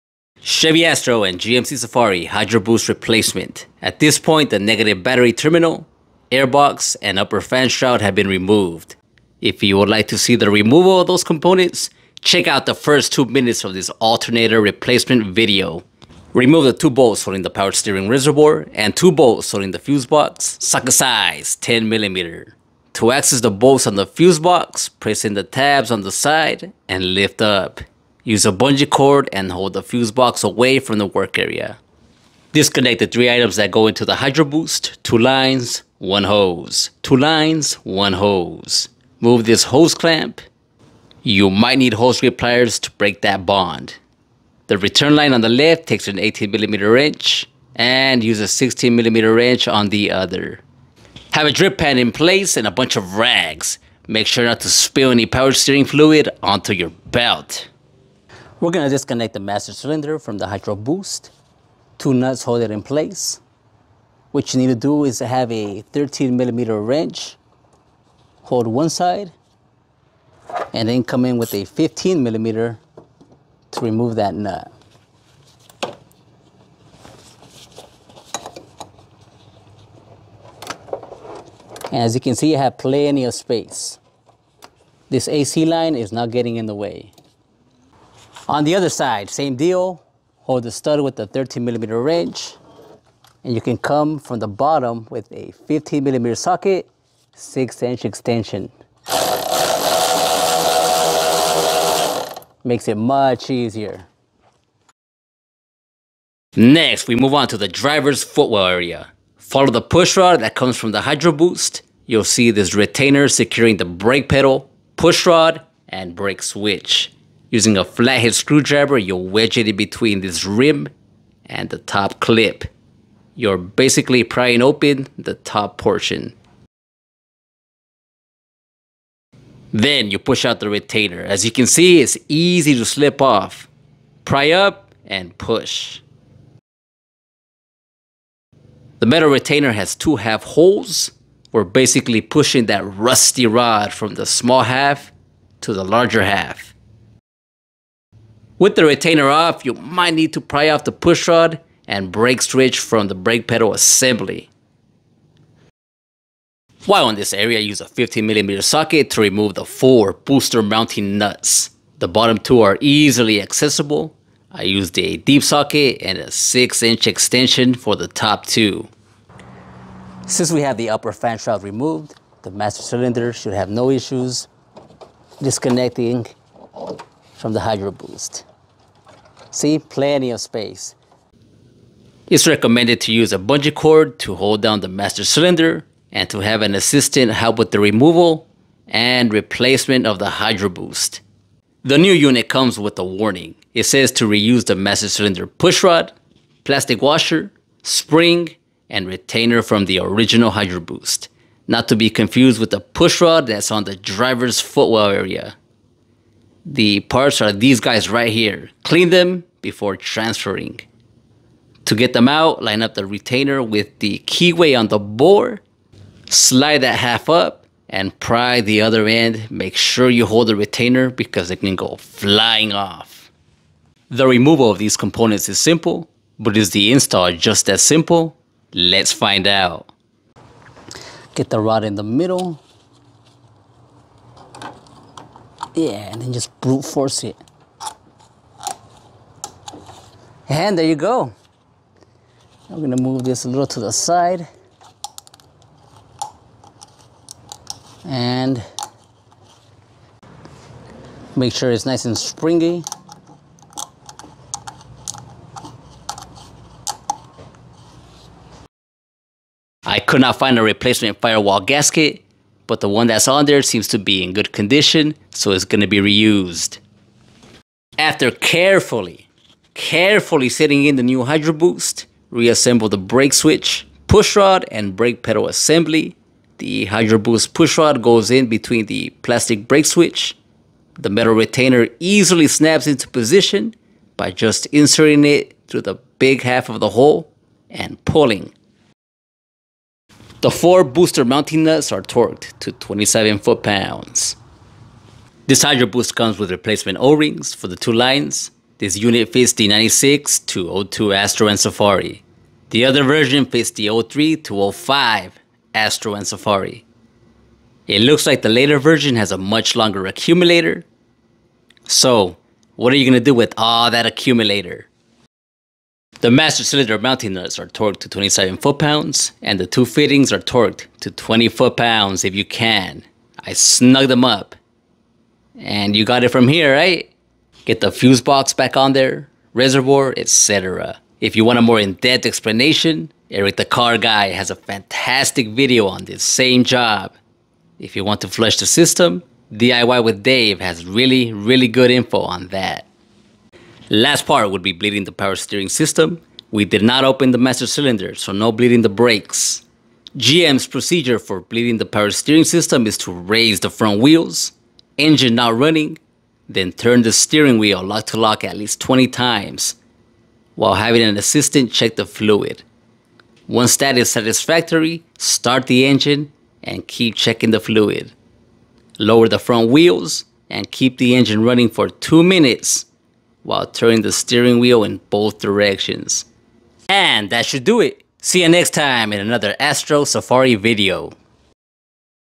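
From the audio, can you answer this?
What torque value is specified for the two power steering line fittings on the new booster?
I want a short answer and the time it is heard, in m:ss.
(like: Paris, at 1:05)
20 foot-pounds, at 5:21.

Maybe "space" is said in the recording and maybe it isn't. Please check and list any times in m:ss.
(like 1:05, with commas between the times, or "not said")
1:23, 3:00.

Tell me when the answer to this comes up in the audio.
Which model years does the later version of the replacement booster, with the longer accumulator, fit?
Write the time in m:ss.
5:04.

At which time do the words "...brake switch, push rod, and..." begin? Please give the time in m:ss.
4:32.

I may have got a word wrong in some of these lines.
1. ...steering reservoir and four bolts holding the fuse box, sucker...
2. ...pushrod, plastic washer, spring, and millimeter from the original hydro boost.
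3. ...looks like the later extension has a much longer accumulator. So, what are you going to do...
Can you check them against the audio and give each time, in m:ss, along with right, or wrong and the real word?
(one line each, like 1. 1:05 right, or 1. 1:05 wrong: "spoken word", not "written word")
1. 0:17 wrong: "two", not "four"
2. 3:15 wrong: "retainer", not "millimeter"
3. 5:08 wrong: "version", not "extension".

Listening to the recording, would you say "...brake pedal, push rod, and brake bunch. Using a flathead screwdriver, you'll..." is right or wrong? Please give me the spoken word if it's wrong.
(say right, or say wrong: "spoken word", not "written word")
wrong: "switch", not "bunch".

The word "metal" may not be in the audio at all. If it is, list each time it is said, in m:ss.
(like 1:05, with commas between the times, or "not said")
2:19, 4:41.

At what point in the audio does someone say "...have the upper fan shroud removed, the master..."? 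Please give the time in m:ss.
2:50.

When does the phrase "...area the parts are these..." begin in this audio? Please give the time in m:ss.
3:25.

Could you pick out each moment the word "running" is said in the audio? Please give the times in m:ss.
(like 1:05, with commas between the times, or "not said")
5:55, 6:11.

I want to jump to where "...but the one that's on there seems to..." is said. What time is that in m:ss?
4:22.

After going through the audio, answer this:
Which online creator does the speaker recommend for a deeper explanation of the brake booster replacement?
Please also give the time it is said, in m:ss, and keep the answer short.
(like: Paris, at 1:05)
Eric the Car Guy, at 5:33.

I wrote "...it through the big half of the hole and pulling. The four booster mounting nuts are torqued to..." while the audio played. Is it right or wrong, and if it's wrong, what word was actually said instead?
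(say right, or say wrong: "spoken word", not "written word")
right.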